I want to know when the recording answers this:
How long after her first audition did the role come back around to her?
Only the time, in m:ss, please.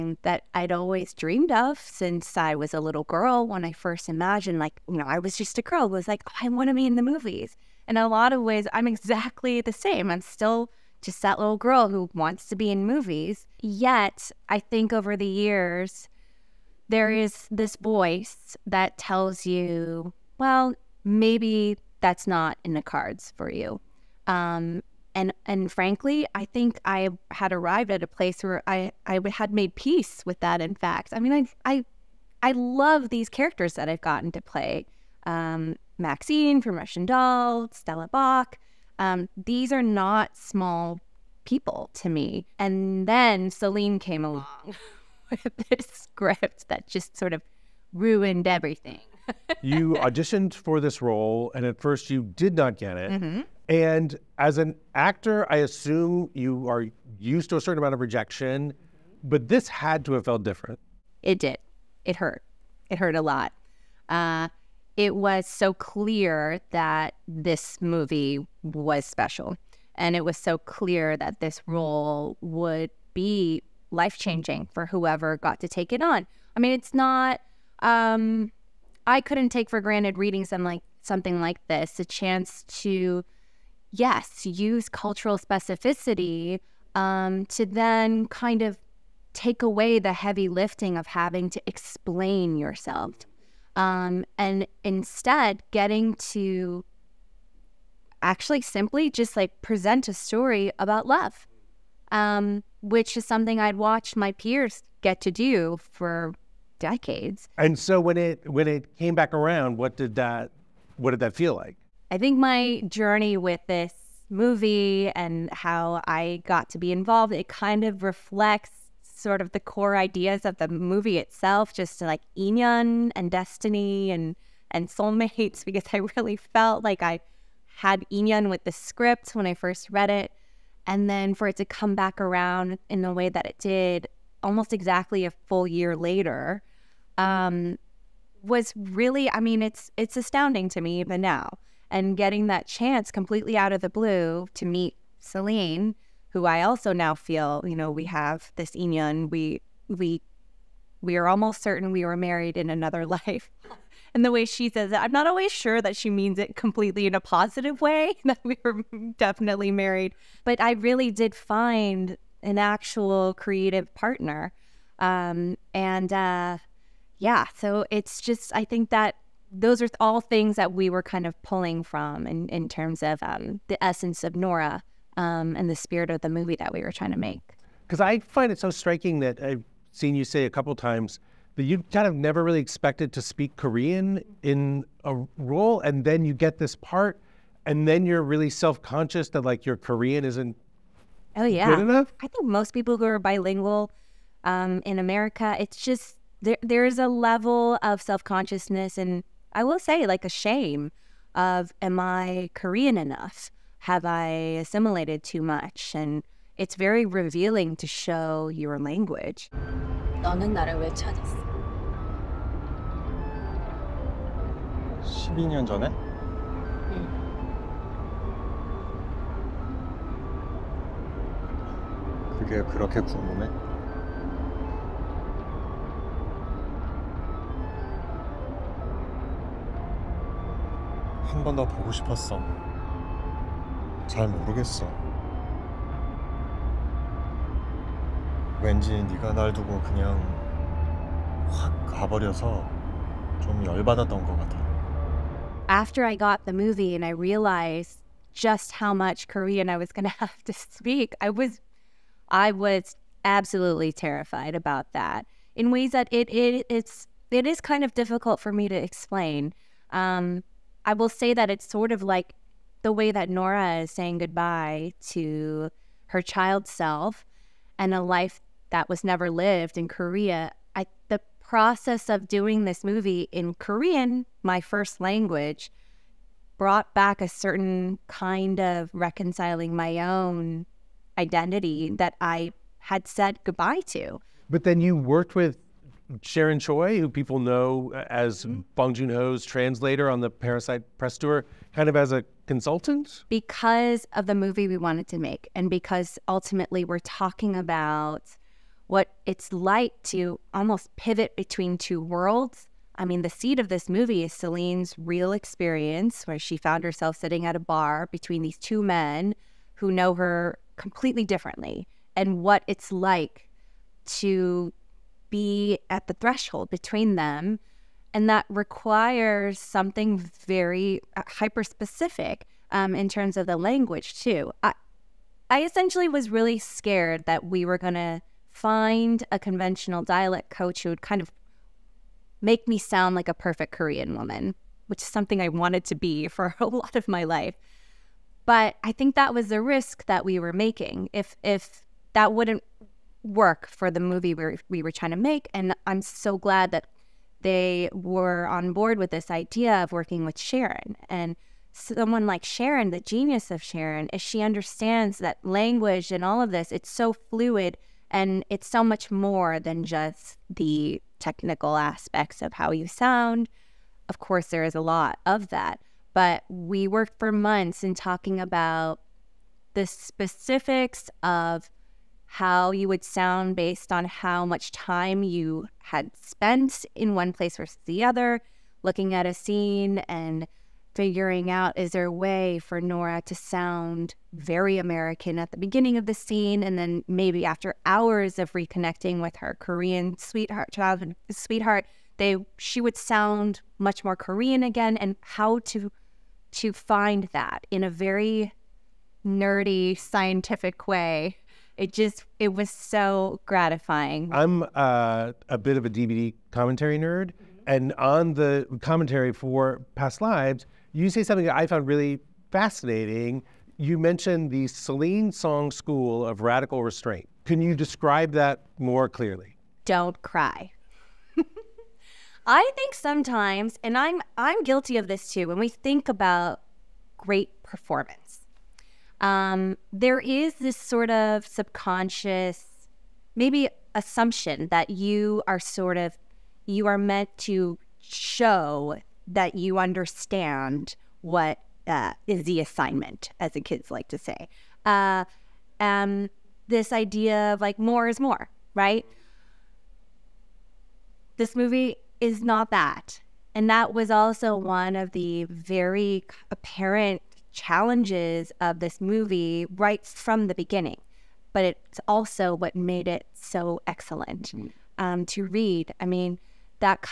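2:15.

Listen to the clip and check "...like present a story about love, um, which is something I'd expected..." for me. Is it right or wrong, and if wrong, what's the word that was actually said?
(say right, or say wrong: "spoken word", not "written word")
wrong: "watched", not "expected".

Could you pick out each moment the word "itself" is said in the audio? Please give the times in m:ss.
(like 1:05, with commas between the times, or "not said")
2:01.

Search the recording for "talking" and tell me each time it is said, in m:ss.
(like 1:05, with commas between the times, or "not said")
4:56, 6:07.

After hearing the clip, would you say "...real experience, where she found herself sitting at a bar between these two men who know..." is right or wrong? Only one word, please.
right.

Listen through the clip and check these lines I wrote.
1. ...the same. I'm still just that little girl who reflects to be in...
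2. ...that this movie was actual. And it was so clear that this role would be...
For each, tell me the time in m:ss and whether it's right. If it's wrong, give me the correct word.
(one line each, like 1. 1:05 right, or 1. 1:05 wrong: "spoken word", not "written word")
1. 0:09 wrong: "wants", not "reflects"
2. 1:06 wrong: "special", not "actual".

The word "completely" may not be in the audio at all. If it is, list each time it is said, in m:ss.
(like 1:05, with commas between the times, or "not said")
2:23, 2:36, 5:10.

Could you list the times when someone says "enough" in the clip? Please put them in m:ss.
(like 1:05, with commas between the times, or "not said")
3:11, 3:22.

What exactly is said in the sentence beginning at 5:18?
And that requires something very uh, hyper specific um, in terms of the language, too.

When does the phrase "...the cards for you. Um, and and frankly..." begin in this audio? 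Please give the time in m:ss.
0:22.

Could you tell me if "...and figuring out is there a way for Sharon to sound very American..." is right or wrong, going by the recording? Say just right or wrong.
wrong.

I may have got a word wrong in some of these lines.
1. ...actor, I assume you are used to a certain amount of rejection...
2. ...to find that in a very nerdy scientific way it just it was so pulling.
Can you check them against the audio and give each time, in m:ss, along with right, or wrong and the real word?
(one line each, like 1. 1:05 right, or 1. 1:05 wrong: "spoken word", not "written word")
1. 0:54 right
2. 6:36 wrong: "gratifying", not "pulling".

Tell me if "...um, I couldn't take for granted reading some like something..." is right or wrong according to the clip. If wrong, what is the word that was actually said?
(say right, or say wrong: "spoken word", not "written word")
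right.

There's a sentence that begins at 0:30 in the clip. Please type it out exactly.
In fact, I mean, I I I love these characters that I've gotten to play.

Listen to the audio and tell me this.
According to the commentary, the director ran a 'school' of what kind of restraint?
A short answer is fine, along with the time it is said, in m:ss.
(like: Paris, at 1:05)
Radical Restraint, at 6:56.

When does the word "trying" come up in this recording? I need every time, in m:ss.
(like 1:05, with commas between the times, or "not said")
2:56, 5:44.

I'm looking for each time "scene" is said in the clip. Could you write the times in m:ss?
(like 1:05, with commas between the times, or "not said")
6:19, 6:26.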